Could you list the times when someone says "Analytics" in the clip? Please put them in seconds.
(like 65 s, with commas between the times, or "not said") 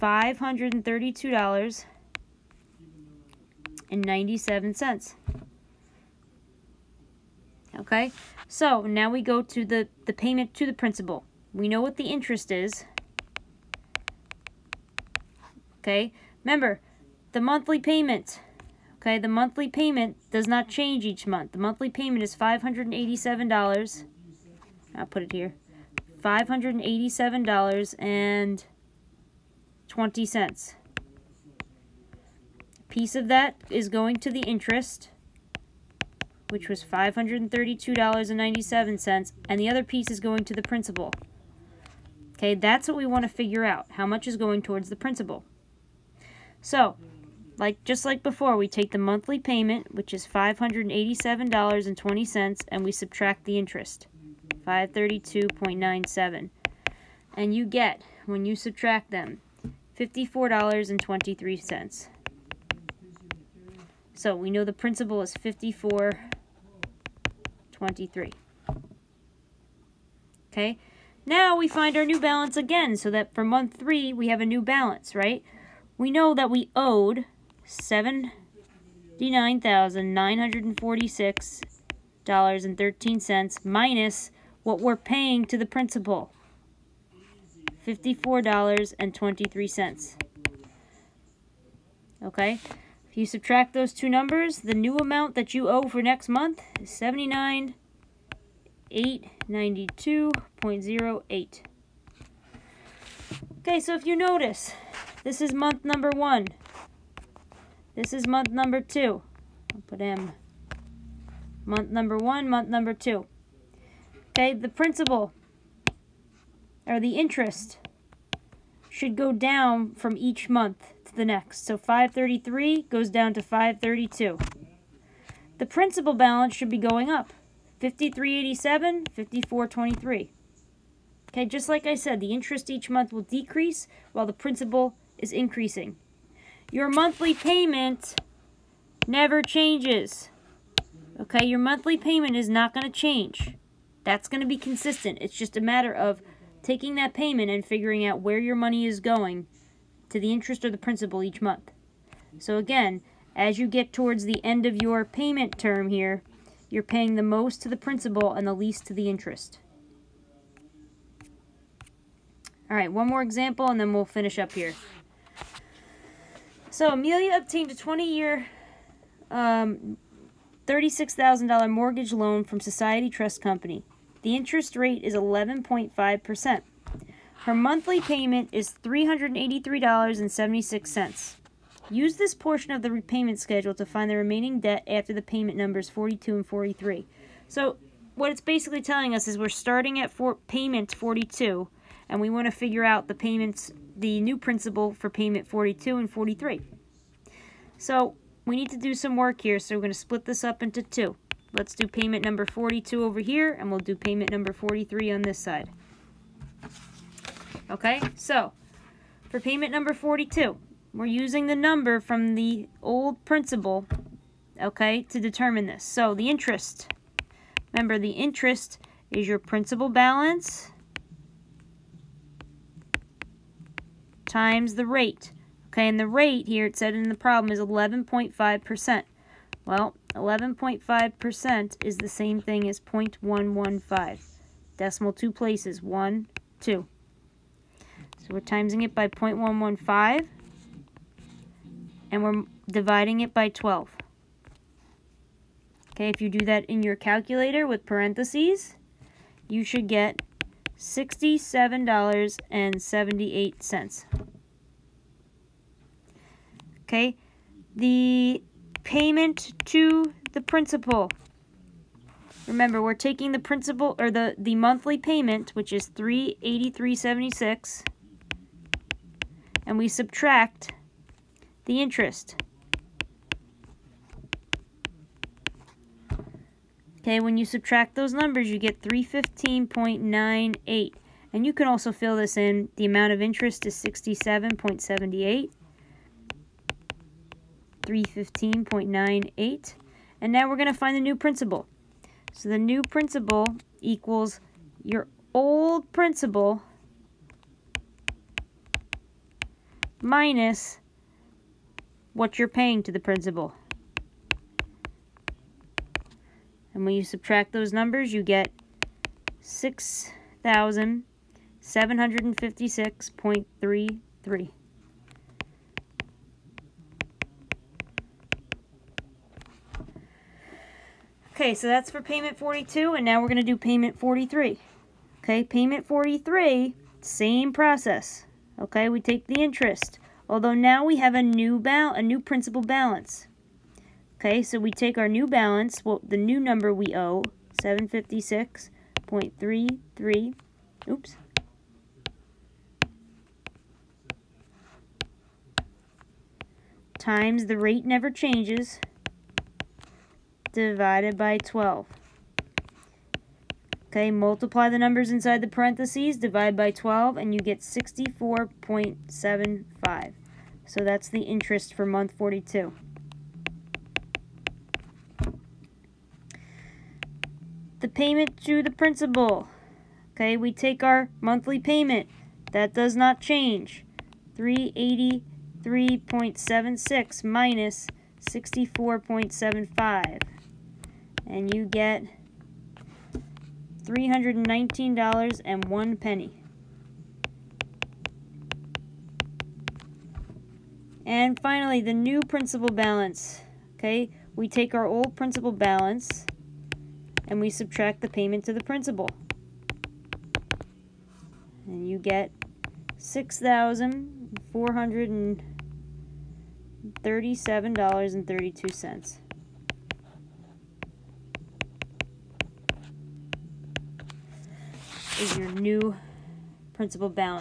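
not said.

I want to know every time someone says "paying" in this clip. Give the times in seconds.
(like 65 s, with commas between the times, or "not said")
84 s, 156 s, 302 s.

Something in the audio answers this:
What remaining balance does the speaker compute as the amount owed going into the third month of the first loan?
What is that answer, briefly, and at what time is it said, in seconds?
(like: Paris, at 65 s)
$79,892.08, at 96 s.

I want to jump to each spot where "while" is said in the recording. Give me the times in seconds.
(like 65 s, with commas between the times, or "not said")
134 s.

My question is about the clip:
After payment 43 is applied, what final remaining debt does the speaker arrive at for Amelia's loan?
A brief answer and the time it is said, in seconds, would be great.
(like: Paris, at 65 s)
$6,437.32, at 402 s.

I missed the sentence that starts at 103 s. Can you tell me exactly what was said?
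Okay, so if you notice, this is month number one.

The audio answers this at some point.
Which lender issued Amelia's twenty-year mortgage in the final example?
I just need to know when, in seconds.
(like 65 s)
172 s.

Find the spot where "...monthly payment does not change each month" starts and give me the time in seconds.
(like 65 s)
19 s.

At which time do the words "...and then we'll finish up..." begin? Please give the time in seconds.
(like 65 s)
163 s.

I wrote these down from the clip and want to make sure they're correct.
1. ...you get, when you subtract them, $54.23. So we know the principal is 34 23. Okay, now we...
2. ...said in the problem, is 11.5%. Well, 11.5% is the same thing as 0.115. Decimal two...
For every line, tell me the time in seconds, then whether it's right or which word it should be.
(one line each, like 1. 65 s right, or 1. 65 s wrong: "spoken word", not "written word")
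1. 57 s wrong: "54", not "34"
2. 226 s right.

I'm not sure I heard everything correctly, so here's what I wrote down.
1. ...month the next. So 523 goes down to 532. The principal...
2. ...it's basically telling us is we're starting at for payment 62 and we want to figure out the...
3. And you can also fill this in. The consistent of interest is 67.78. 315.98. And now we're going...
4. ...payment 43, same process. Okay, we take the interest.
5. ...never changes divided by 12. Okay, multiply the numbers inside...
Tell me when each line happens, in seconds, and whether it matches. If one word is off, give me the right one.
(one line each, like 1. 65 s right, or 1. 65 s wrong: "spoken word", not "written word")
1. 120 s wrong: "533", not "523"
2. 188 s wrong: "42", not "62"
3. 281 s wrong: "amount", not "consistent"
4. 325 s right
5. 347 s right.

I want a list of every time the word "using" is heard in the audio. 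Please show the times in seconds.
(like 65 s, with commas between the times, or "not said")
211 s.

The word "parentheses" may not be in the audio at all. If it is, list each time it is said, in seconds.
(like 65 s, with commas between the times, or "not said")
247 s, 355 s.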